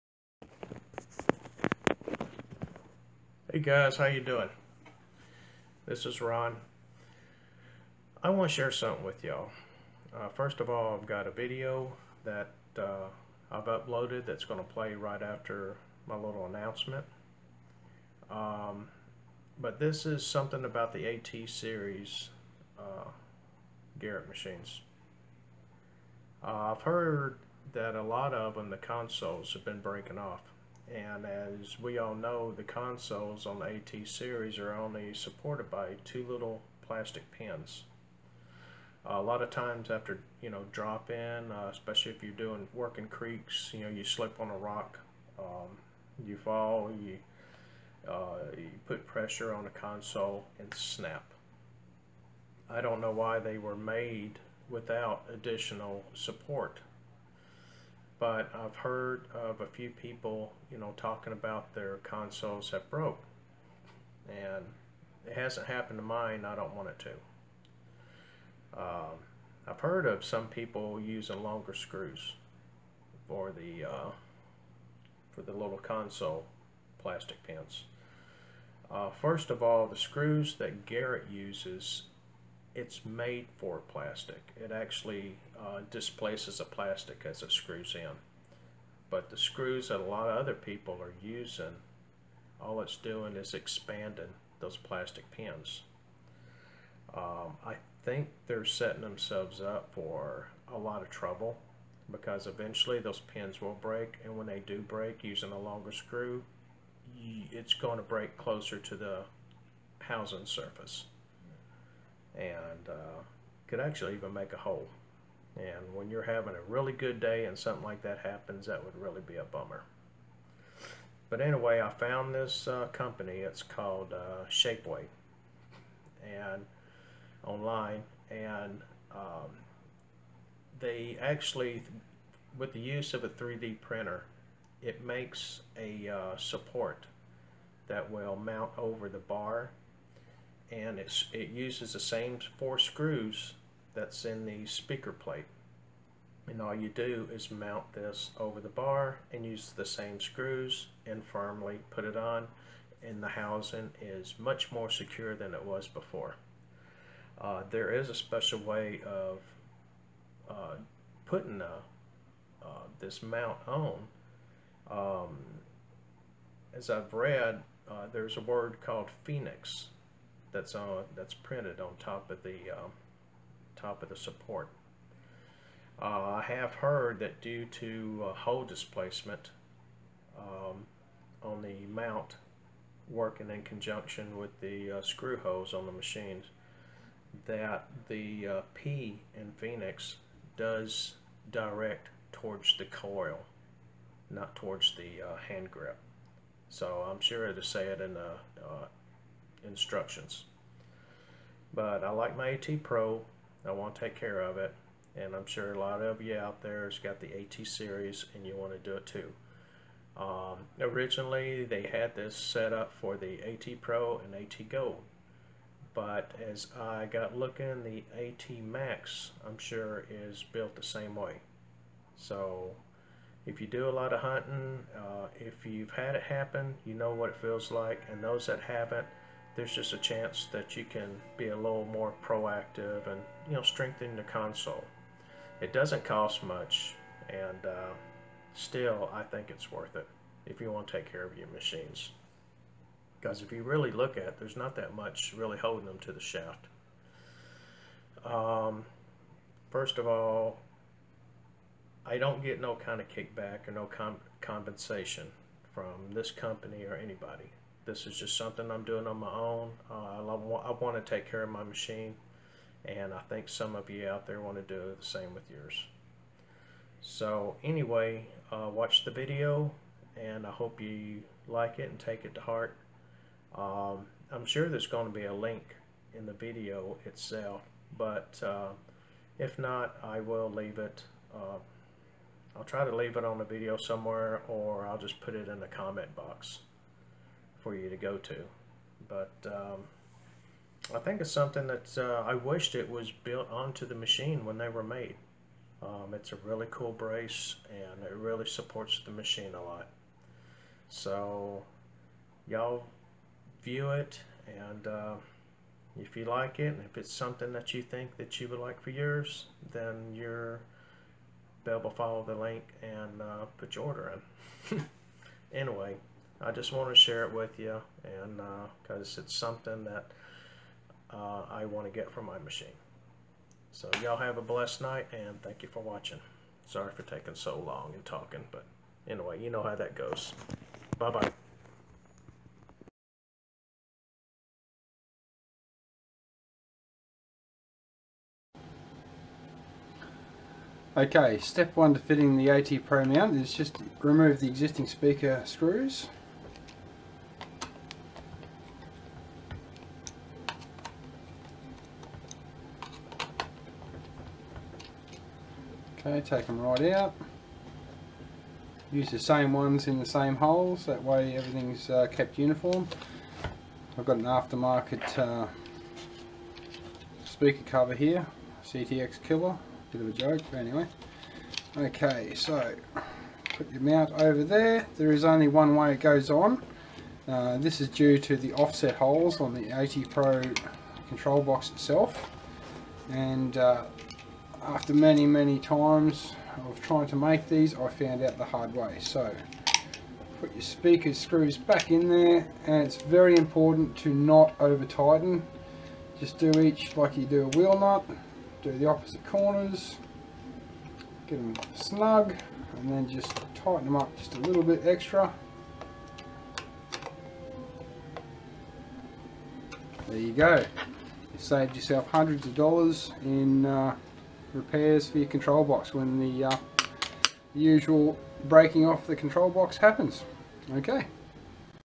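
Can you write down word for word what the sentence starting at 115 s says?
And when you're having a really good day and something like that happens, that would really be a bummer.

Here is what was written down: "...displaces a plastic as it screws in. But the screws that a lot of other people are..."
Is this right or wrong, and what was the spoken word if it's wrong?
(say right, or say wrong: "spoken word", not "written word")
right.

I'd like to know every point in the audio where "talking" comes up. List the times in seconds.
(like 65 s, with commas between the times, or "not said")
60 s, 328 s.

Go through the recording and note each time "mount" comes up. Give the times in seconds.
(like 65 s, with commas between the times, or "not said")
138 s, 147 s, 163 s, 181 s, 343 s, 373 s.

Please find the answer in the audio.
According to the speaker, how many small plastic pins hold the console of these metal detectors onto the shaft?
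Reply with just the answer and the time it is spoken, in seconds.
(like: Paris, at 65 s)
2, at 36 s.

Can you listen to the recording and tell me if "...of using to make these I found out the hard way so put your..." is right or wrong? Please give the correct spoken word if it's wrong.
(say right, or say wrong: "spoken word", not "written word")
wrong: "trying", not "using".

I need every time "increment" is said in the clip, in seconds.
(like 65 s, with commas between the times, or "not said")
not said.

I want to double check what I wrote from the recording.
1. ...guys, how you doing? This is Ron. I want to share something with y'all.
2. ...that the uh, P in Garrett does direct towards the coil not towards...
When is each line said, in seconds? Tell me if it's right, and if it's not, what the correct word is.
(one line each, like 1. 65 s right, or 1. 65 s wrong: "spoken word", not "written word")
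1. 3 s right
2. 187 s wrong: "Phoenix", not "Garrett".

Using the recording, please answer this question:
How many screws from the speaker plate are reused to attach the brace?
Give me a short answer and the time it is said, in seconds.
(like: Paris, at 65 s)
4, at 142 s.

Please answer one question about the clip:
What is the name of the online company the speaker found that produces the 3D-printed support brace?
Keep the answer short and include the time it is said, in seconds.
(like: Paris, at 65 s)
Shapeways, at 124 s.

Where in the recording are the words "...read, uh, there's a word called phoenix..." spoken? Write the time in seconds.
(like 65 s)
167 s.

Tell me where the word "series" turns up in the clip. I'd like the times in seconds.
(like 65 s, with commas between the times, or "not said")
21 s, 34 s, 207 s.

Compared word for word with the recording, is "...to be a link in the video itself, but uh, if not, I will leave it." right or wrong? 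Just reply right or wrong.
right.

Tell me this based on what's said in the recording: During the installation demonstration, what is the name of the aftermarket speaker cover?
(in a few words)
CTX Killer.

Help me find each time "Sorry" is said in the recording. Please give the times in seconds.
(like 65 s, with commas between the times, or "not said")
326 s.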